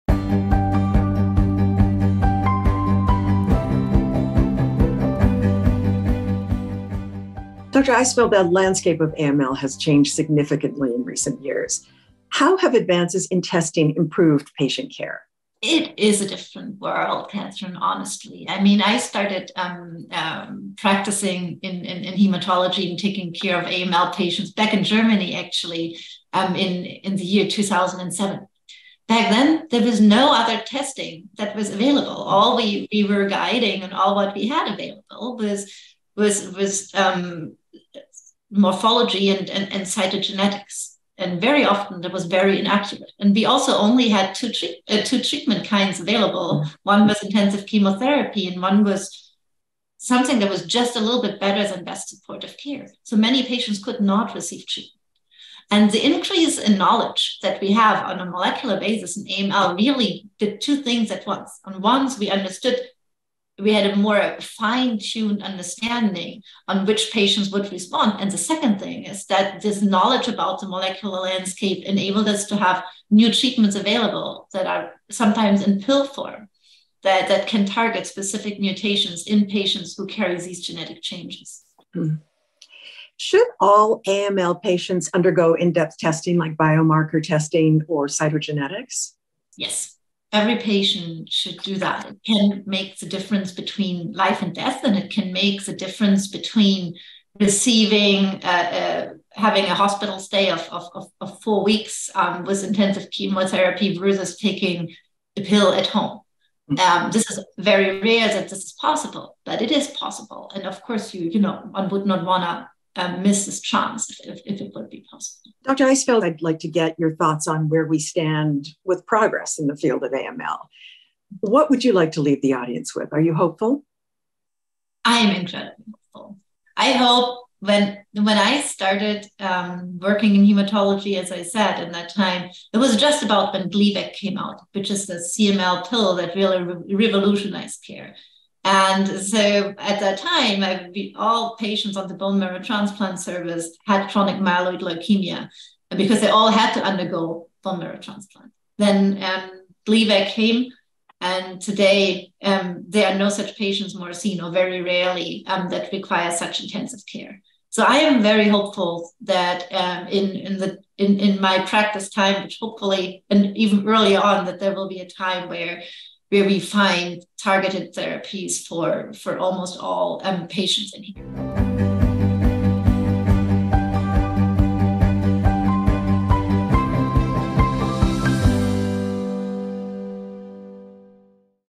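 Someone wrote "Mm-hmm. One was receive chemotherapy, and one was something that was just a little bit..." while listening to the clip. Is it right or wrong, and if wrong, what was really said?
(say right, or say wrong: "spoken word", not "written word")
wrong: "intensive", not "receive".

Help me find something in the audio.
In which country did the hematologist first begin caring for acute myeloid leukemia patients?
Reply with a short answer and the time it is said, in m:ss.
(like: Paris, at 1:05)
Germany, at 0:24.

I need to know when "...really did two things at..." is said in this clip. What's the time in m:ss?
0:59.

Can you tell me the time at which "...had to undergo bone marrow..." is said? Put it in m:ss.
2:26.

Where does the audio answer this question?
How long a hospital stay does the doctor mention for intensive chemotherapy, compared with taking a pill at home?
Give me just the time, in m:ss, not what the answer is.
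1:41.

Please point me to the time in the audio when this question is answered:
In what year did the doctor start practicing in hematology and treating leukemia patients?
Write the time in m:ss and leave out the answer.
0:27.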